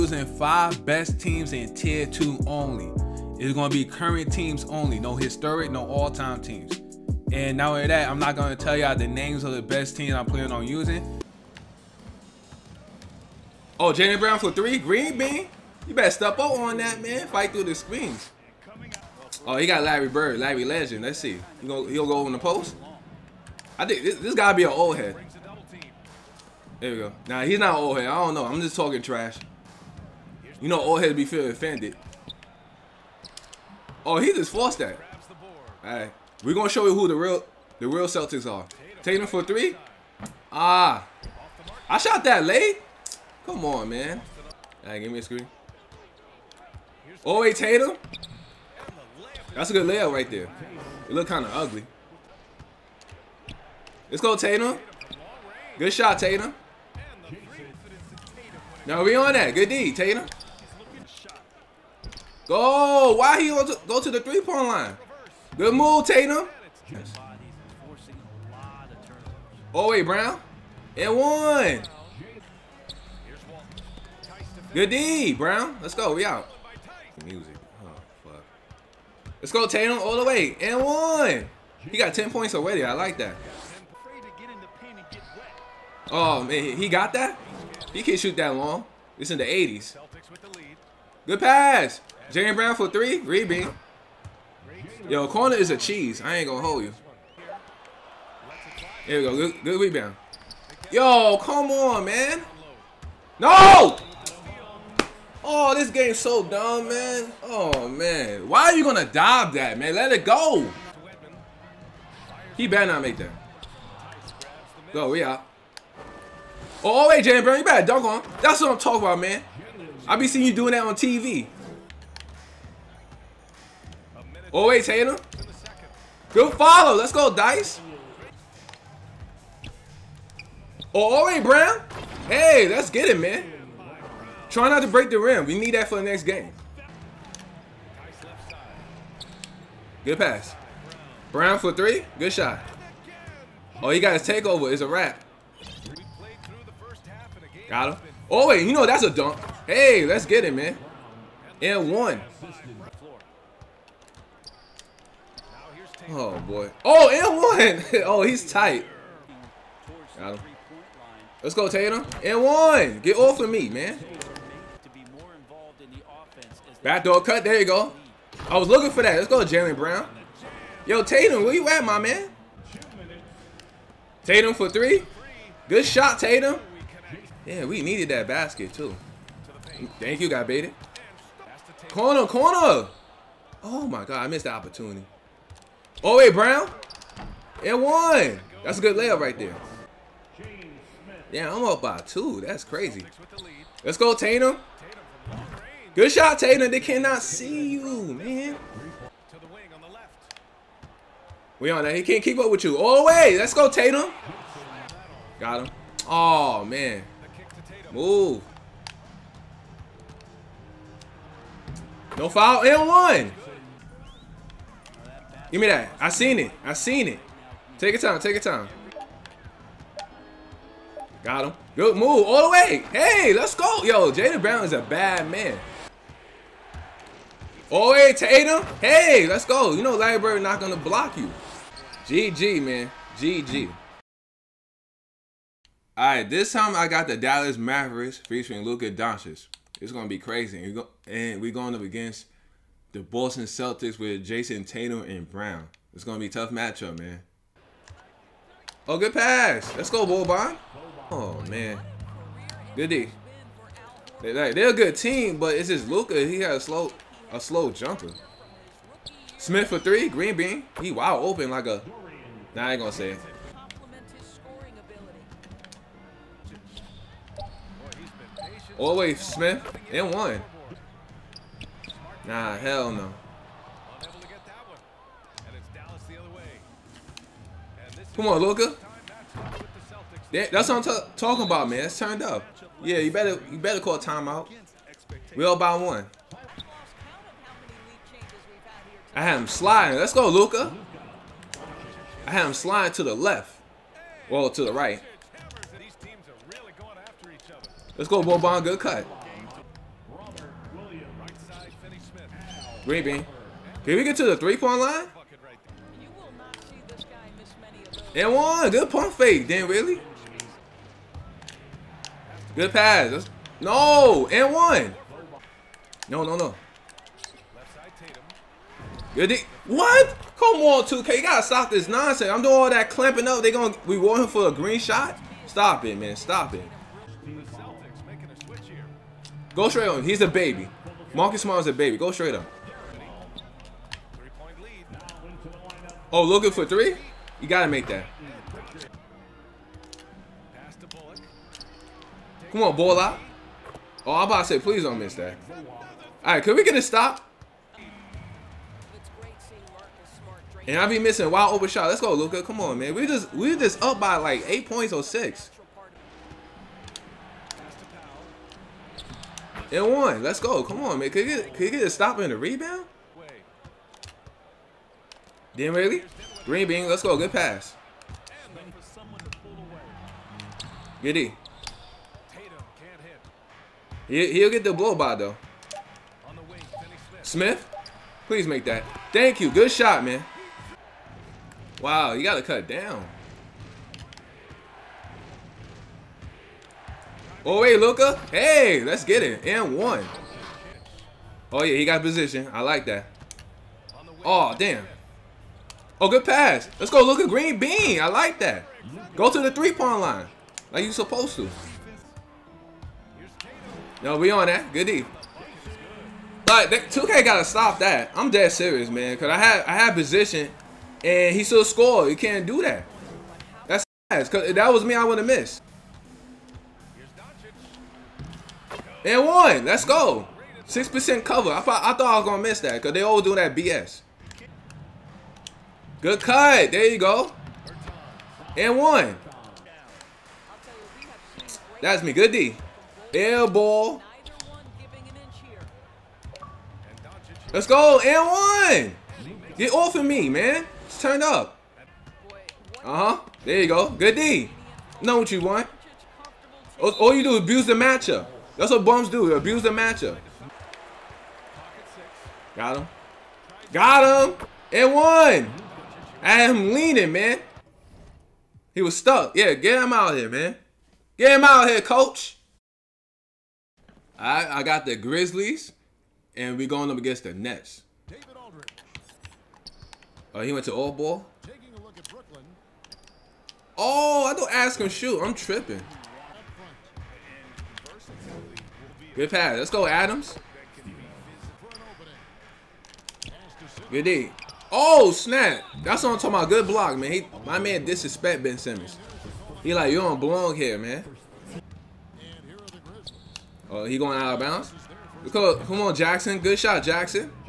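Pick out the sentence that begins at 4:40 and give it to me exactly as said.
That, that's what I'm talking about, man.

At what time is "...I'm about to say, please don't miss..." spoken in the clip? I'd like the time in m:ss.
5:44.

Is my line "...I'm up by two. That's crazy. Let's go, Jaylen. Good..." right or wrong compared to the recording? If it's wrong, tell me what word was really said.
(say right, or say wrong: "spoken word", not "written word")
wrong: "Tatum", not "Jaylen".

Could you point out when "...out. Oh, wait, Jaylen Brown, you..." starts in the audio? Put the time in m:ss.
1:55.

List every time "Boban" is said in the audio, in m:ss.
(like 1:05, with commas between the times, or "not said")
4:10, 4:58.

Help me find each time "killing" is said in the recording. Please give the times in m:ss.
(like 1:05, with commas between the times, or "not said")
not said.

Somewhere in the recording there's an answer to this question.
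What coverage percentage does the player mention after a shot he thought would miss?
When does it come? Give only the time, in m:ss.
7:00.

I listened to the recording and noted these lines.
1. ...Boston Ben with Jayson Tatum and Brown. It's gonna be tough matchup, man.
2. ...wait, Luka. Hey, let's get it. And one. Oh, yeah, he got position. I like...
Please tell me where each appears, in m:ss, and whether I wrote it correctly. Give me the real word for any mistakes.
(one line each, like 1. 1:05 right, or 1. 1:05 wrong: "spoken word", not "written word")
1. 4:03 wrong: "Celtics", not "Ben"
2. 6:27 right.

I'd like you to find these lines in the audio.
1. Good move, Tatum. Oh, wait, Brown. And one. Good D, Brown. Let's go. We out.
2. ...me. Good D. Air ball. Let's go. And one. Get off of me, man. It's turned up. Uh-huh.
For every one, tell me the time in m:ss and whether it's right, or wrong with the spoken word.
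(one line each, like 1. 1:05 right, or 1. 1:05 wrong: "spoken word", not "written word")
1. 1:05 right
2. 7:12 right.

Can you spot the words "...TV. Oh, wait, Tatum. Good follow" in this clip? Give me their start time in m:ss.
2:00.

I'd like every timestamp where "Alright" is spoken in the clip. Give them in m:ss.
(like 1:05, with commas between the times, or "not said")
0:35, 0:44.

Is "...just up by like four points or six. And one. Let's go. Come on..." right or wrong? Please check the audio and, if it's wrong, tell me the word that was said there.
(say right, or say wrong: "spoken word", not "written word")
wrong: "eight", not "four".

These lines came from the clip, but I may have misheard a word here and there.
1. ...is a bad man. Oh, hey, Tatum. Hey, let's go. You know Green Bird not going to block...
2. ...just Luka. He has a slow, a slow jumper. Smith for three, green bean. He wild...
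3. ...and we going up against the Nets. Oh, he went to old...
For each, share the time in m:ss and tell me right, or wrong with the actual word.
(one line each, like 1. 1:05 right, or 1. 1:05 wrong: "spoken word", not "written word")
1. 3:44 wrong: "Larry", not "Green"
2. 4:15 right
3. 7:46 right.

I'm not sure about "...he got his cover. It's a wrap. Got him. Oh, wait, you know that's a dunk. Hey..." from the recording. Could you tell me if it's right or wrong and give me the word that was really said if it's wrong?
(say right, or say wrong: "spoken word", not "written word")
wrong: "takeover", not "cover".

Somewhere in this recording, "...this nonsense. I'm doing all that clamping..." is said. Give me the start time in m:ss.
5:21.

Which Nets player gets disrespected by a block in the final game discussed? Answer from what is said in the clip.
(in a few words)
Ben Simmons.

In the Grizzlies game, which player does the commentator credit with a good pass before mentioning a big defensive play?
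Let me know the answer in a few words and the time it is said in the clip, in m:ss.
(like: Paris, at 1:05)
Adams, at 7:59.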